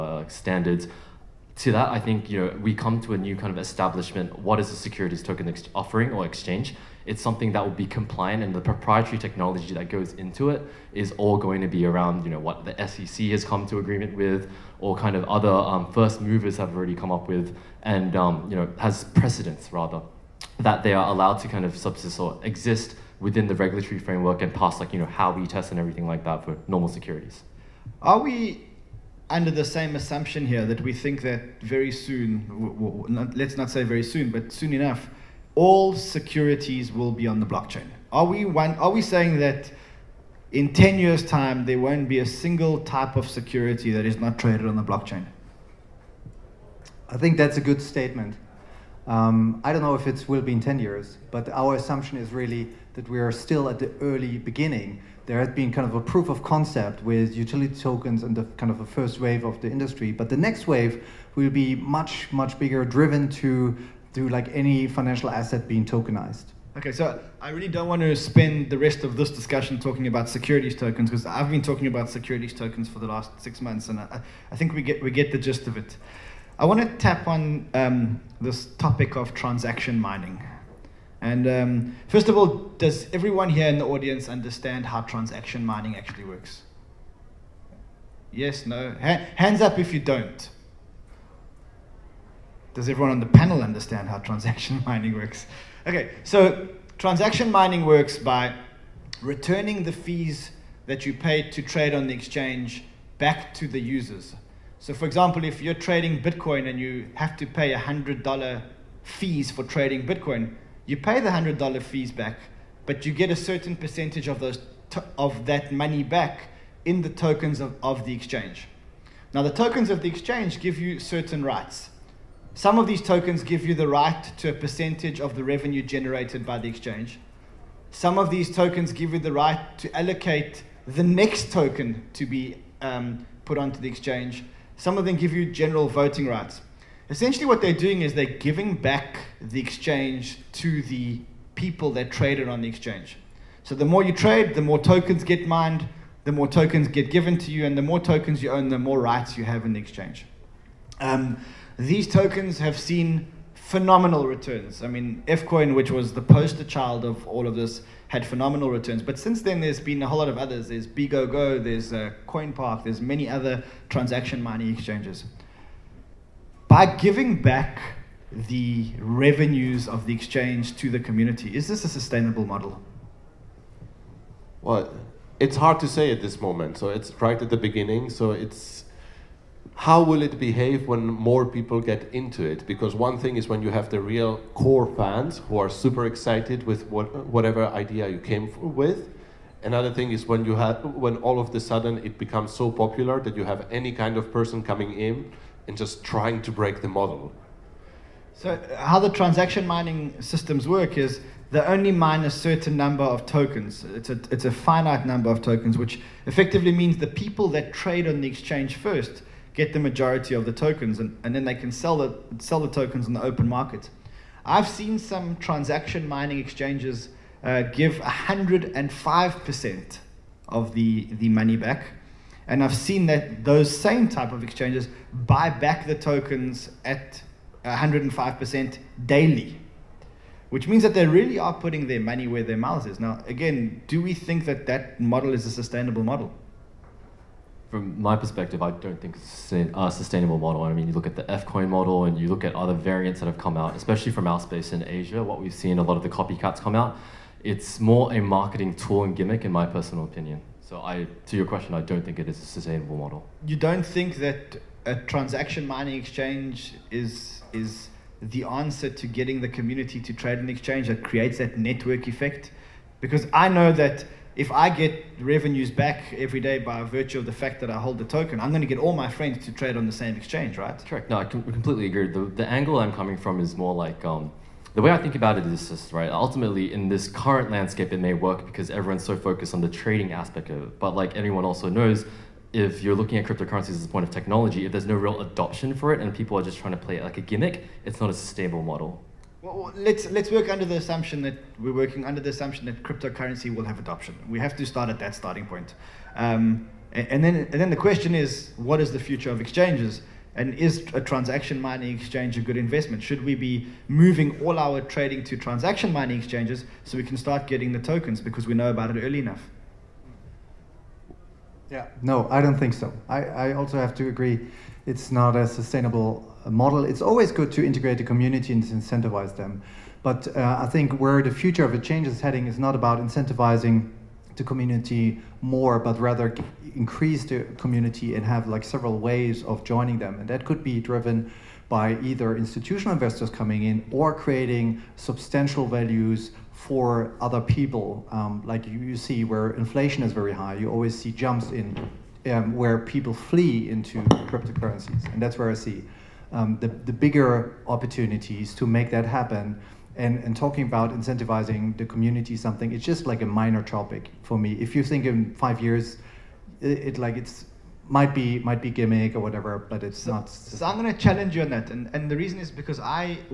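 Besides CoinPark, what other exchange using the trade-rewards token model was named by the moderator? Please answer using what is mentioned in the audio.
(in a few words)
BGoGo.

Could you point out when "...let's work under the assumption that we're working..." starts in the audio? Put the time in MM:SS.
04:50.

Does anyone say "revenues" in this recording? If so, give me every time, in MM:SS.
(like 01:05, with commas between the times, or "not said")
02:05, 02:48, 04:25.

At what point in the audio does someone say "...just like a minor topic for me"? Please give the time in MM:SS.
05:52.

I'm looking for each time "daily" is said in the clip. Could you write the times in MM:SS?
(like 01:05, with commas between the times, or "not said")
03:49.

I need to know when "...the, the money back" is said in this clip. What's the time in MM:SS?
03:40.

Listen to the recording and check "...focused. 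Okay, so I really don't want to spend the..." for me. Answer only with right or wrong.
wrong.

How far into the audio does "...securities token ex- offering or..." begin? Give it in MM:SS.
00:04.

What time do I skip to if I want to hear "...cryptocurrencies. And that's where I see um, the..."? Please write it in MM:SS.
05:44.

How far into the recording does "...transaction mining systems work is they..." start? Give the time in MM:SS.
03:19.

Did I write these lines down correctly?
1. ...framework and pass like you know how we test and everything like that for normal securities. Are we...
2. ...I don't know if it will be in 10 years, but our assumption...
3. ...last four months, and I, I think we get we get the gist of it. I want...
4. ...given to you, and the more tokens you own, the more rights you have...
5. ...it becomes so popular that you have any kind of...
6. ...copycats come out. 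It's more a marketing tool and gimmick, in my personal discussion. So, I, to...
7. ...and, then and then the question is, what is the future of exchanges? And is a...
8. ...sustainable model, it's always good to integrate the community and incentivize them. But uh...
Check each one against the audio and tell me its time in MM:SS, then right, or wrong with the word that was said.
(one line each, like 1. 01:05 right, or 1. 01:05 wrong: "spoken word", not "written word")
1. 00:23 right
2. 00:49 right
3. 01:13 wrong: "six", not "four"
4. 02:27 right
5. 03:12 right
6. 04:06 wrong: "opinion", not "discussion"
7. 04:57 right
8. 05:15 right.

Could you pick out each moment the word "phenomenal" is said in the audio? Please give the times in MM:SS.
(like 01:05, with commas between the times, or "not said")
02:33, 02:38.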